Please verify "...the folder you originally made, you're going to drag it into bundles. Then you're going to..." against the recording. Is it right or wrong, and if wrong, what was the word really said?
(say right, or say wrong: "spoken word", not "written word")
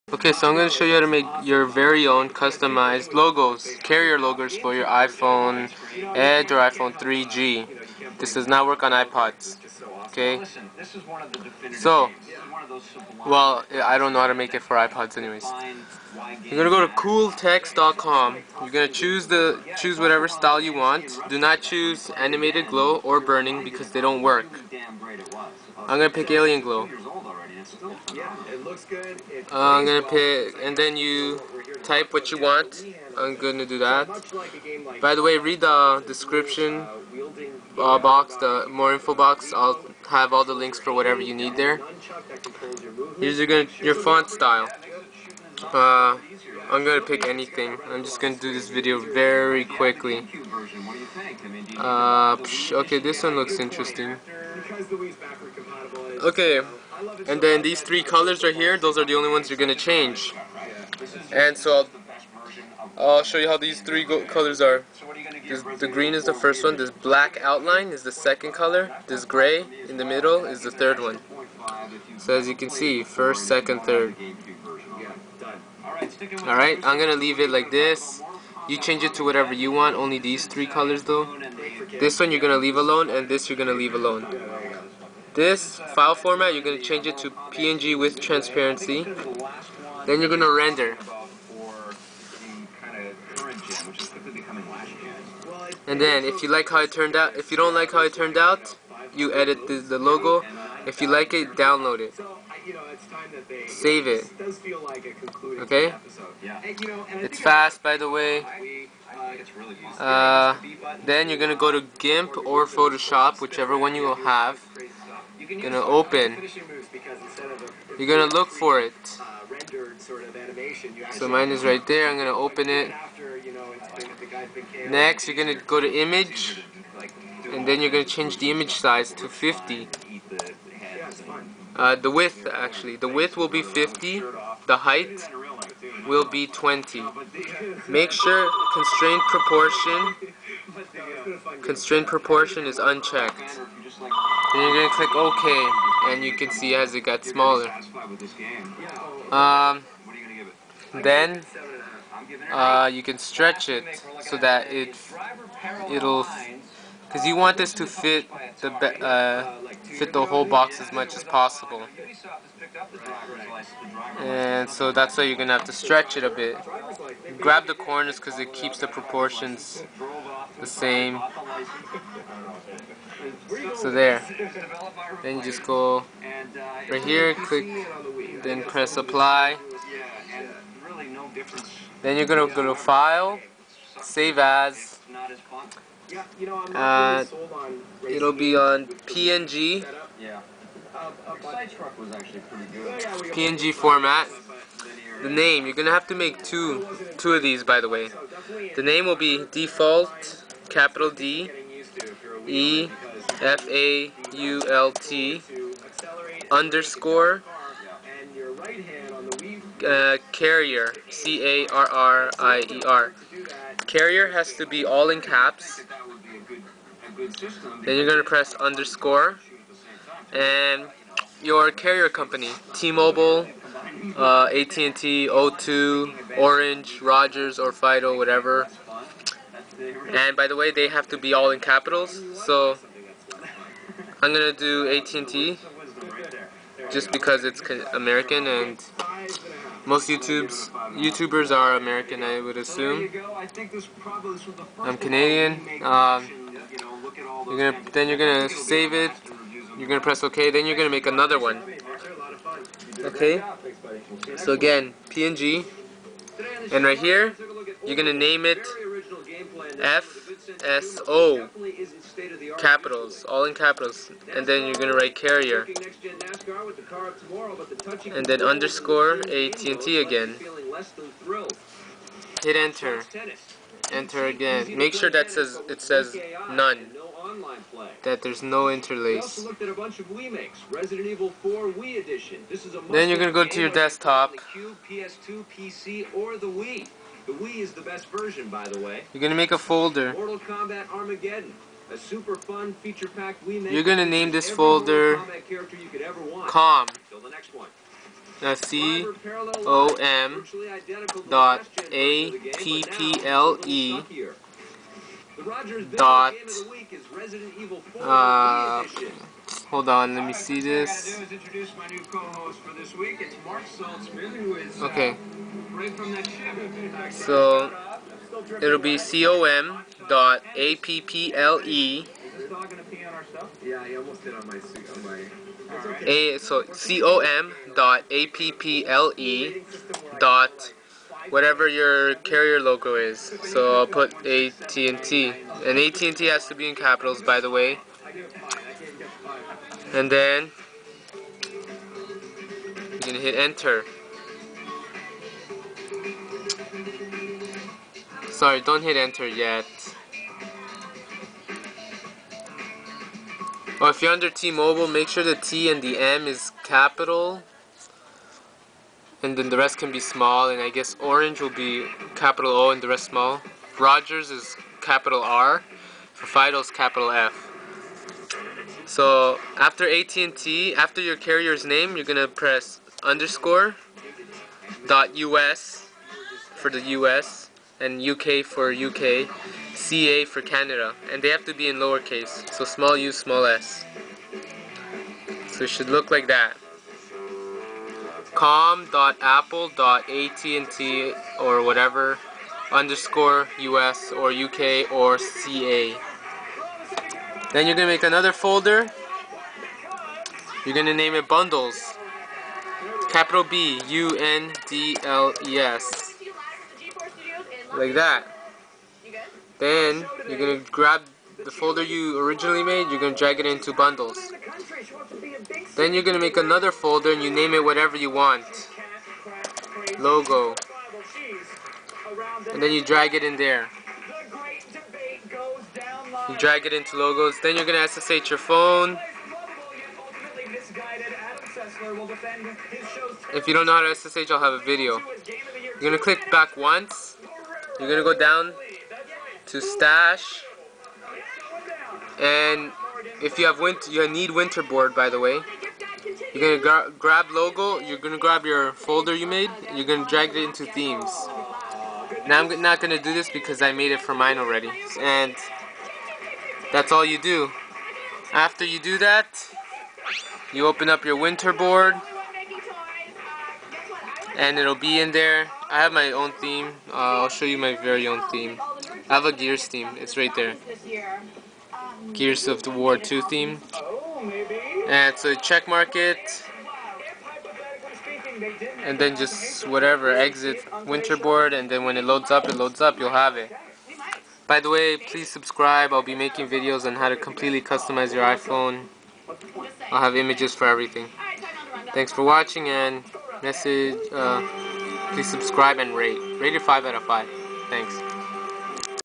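right.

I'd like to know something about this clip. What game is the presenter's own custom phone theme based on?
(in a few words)
Gears of War 2.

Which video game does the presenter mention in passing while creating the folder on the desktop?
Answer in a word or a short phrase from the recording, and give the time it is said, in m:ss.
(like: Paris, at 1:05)
Mortal Kombat Armageddon, at 4:50.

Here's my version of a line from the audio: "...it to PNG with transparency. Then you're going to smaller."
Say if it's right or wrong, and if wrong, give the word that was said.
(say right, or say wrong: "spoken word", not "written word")
wrong: "render", not "smaller".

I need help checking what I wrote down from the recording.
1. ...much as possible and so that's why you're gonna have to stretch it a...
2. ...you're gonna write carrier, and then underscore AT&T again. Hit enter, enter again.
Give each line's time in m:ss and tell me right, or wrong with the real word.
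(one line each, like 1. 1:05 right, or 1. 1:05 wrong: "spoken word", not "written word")
1. 2:40 right
2. 4:24 right.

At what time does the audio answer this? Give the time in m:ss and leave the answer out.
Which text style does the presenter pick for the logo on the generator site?
0:26.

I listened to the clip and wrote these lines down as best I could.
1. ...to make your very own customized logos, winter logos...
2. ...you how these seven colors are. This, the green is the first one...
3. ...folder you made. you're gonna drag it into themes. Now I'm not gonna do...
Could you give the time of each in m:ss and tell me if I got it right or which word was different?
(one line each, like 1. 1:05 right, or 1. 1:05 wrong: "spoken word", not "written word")
1. 0:00 wrong: "carrier", not "winter"
2. 1:03 wrong: "three", not "seven"
3. 7:28 right.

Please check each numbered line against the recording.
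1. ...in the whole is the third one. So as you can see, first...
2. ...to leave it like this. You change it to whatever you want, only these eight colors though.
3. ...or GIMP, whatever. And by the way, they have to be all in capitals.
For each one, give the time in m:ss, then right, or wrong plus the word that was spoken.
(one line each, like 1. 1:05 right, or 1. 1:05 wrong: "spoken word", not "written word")
1. 1:09 wrong: "middle", not "whole"
2. 1:17 wrong: "three", not "eight"
3. 3:47 wrong: "Fido", not "GIMP".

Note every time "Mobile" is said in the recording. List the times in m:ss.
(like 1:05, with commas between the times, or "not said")
3:42, 5:54.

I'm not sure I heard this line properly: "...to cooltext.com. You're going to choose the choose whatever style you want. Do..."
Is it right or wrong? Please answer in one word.
right.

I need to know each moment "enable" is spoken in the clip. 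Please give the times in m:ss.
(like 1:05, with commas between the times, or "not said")
not said.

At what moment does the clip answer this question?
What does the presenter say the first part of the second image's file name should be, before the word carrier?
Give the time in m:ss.
4:19.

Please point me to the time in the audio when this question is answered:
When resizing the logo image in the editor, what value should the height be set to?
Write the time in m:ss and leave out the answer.
2:16.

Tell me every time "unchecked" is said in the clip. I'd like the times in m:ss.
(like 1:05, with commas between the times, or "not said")
2:22.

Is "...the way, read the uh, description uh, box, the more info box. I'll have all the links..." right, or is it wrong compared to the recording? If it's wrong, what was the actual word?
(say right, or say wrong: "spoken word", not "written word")
right.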